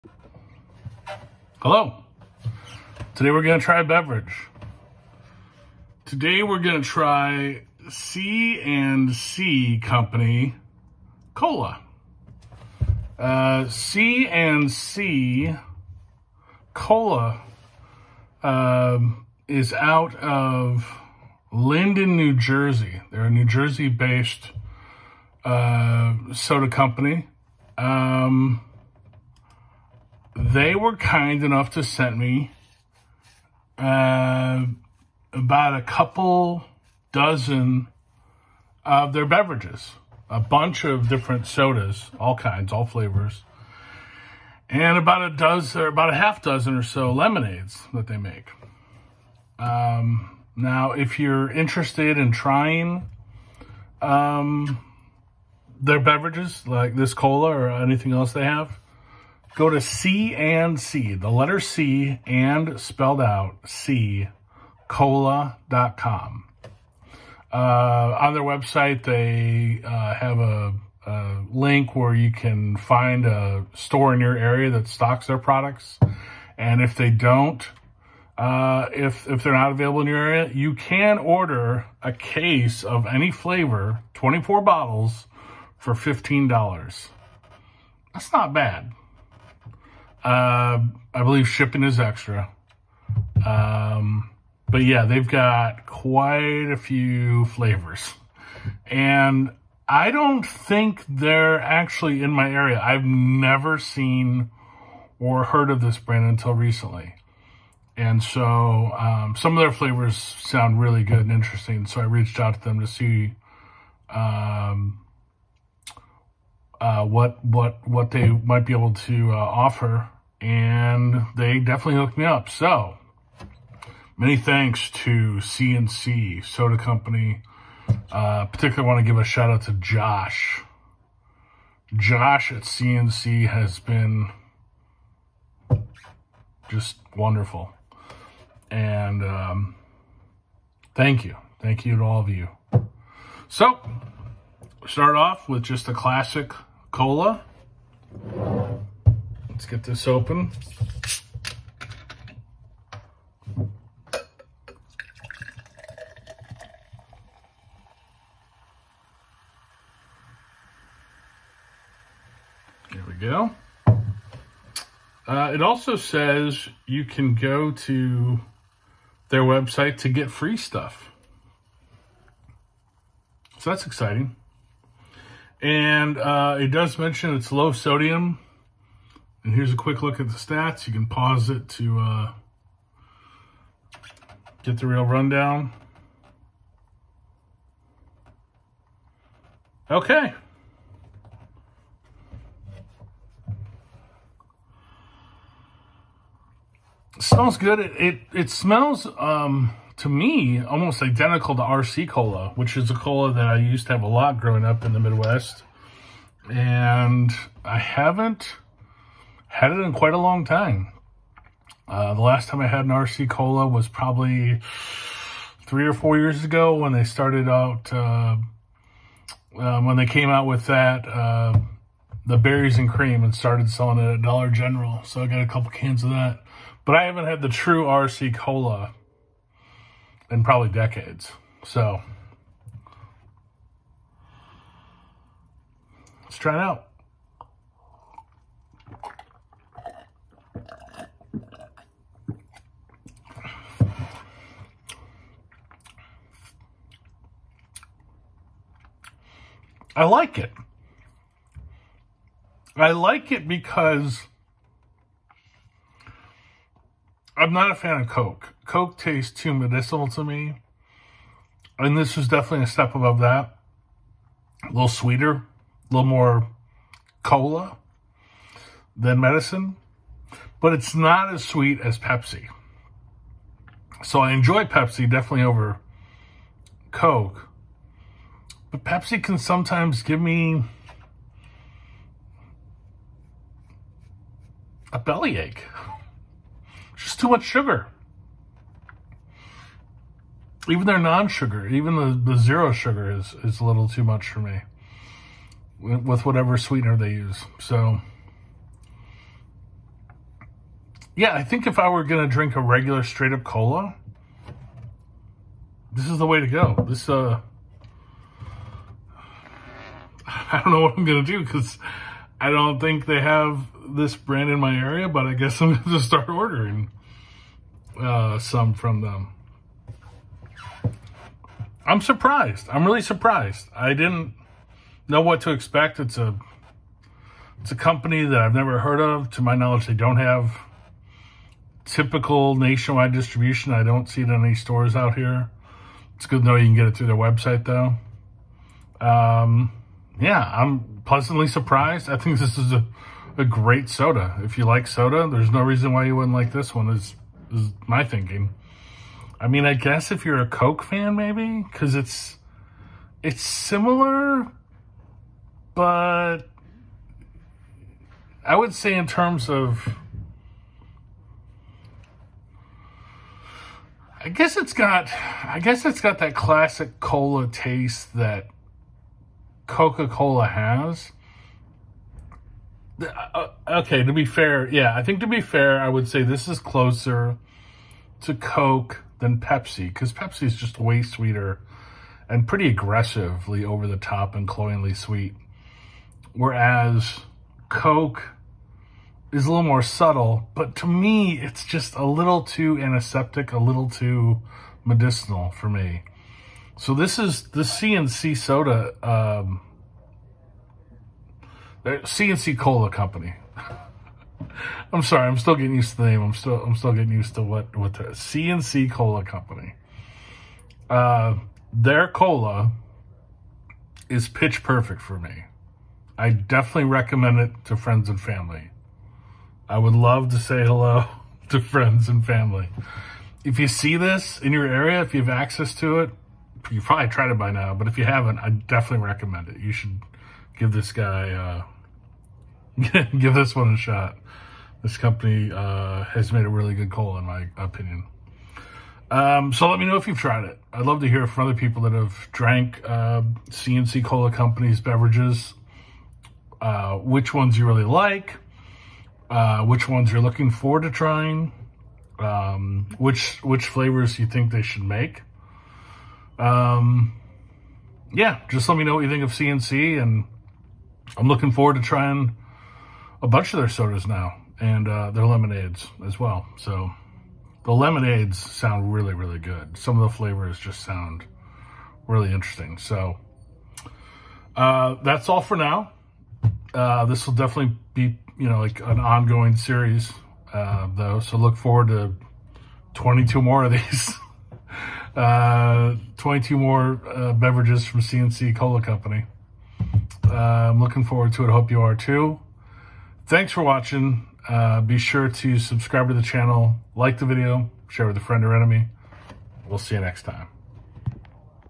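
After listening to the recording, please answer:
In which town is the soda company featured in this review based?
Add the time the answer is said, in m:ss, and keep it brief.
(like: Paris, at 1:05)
Linden, New Jersey, at 0:21.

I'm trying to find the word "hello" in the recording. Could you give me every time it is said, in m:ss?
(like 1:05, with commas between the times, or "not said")
0:01, 7:00.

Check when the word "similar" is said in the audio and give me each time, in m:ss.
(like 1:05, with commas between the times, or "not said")
5:53.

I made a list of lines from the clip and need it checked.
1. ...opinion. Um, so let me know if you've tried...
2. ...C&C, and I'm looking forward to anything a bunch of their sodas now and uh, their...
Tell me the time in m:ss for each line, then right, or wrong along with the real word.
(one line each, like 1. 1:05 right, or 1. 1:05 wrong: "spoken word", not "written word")
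1. 7:17 right
2. 7:39 wrong: "trying", not "anything".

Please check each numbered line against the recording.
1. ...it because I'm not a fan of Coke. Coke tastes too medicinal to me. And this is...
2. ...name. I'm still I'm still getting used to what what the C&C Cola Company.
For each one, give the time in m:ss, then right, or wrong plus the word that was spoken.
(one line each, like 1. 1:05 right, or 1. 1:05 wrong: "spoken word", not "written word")
1. 4:13 right
2. 6:46 right.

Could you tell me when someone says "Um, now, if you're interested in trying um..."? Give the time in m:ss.
0:49.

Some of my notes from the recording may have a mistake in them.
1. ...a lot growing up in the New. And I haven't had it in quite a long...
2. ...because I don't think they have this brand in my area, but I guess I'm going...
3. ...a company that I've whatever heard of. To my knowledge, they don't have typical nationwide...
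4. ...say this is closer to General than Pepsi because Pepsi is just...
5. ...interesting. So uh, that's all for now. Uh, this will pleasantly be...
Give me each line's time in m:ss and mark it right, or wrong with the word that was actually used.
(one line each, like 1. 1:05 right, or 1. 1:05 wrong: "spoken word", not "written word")
1. 3:24 wrong: "Midwest", not "New"
2. 5:11 right
3. 5:27 wrong: "never", not "whatever"
4. 6:16 wrong: "Coke", not "General"
5. 7:52 wrong: "definitely", not "pleasantly".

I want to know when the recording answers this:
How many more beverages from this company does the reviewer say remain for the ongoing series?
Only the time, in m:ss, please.
8:06.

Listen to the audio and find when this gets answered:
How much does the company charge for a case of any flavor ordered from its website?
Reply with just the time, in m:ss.
1:25.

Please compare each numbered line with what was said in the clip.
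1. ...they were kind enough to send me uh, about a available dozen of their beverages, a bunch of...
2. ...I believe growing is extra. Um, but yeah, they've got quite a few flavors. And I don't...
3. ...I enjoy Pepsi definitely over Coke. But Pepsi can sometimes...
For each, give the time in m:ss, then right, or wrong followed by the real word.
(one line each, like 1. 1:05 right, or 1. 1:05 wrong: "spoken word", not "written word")
1. 0:30 wrong: "couple", not "available"
2. 1:31 wrong: "shipping", not "growing"
3. 4:34 right.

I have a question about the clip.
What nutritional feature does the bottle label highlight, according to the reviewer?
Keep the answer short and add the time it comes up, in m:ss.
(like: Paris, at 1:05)
Low sodium, at 2:57.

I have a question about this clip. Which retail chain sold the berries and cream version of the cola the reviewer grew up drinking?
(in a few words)
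Dollar General.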